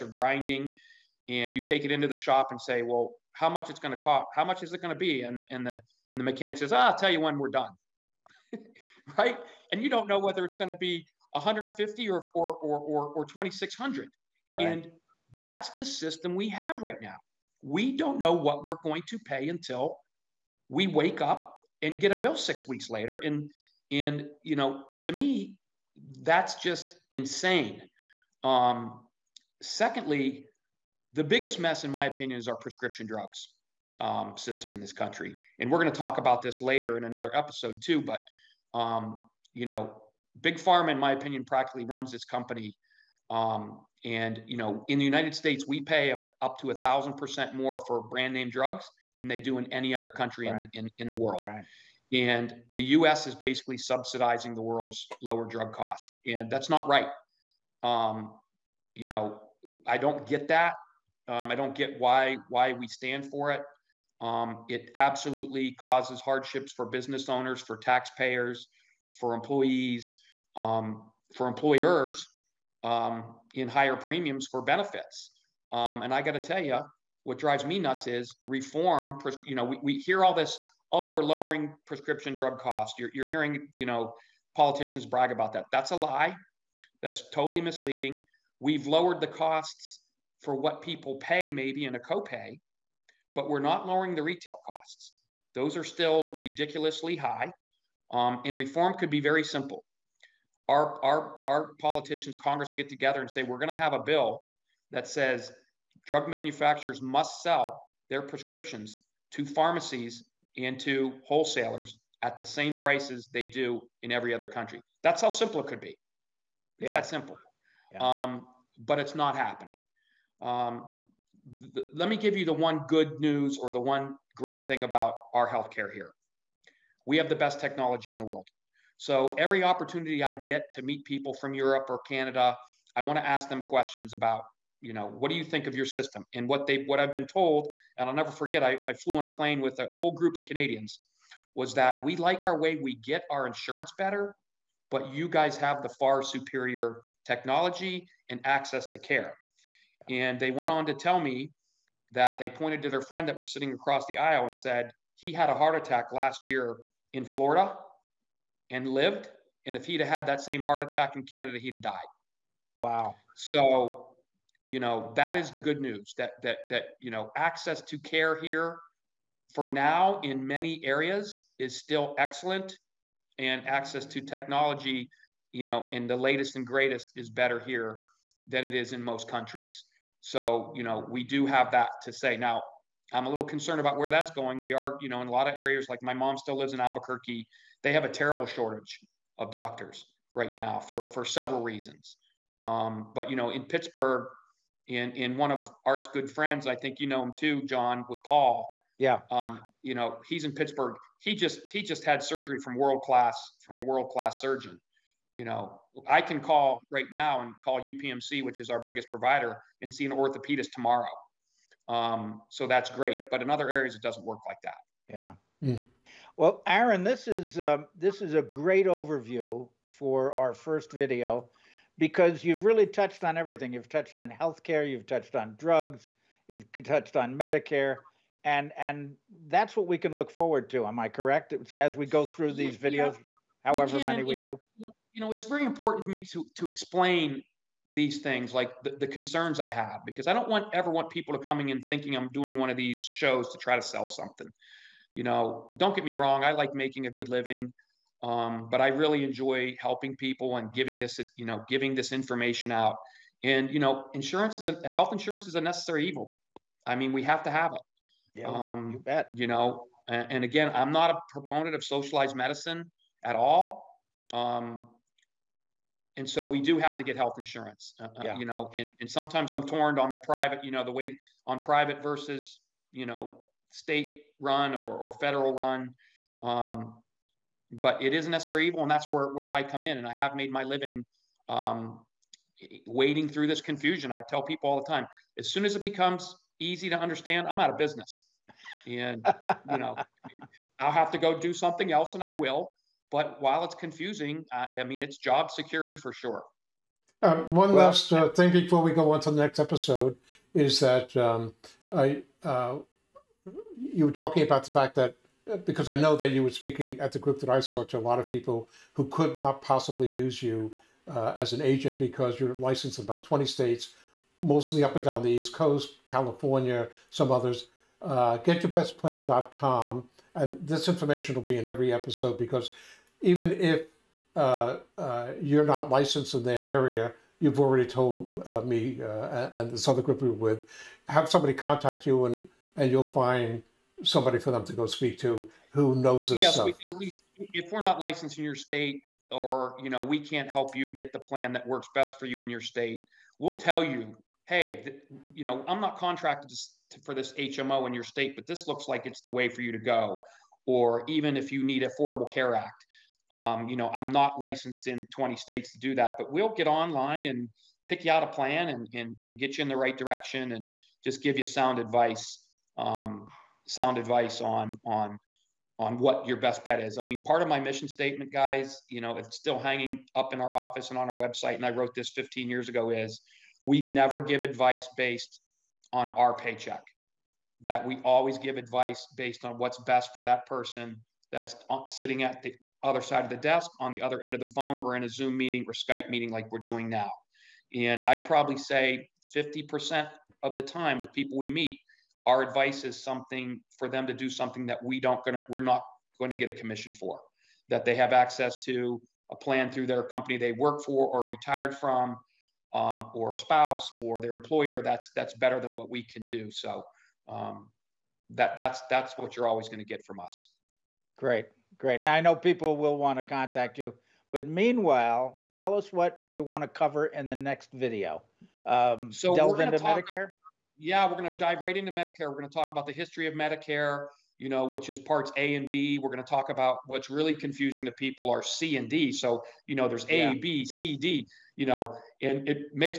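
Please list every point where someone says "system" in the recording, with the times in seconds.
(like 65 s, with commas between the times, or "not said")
15 s, 34 s, 135 s.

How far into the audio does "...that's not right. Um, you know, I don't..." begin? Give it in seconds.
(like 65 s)
56 s.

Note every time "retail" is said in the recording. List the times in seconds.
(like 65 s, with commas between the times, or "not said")
94 s.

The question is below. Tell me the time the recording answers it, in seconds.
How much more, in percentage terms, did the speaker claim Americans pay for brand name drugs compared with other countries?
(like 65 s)
46 s.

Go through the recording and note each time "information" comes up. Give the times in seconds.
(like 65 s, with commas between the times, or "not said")
252 s, 320 s.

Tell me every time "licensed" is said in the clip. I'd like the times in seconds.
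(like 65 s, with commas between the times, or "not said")
312 s, 325 s, 337 s, 354 s.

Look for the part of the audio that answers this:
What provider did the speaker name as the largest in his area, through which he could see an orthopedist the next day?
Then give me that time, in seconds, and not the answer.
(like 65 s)
207 s.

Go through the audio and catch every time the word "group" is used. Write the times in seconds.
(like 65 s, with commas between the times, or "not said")
140 s, 307 s, 330 s.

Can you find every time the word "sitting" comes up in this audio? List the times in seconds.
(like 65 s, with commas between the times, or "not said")
153 s, 381 s.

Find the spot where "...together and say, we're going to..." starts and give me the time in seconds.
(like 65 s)
102 s.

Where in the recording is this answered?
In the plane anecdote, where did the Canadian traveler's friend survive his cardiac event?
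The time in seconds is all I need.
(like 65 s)
157 s.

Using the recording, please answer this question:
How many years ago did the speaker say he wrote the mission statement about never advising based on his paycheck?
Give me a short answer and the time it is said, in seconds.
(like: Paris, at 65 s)
15, at 372 s.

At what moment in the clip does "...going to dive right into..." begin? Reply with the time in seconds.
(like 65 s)
421 s.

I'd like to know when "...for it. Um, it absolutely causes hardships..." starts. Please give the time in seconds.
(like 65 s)
63 s.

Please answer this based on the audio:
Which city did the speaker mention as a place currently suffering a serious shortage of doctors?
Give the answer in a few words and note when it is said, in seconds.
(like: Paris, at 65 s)
Albuquerque, at 186 s.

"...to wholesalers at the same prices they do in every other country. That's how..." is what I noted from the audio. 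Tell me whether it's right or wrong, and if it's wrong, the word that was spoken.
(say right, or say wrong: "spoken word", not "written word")
right.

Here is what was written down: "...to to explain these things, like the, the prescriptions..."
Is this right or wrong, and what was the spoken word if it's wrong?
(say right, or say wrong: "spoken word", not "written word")
wrong: "concerns", not "prescriptions".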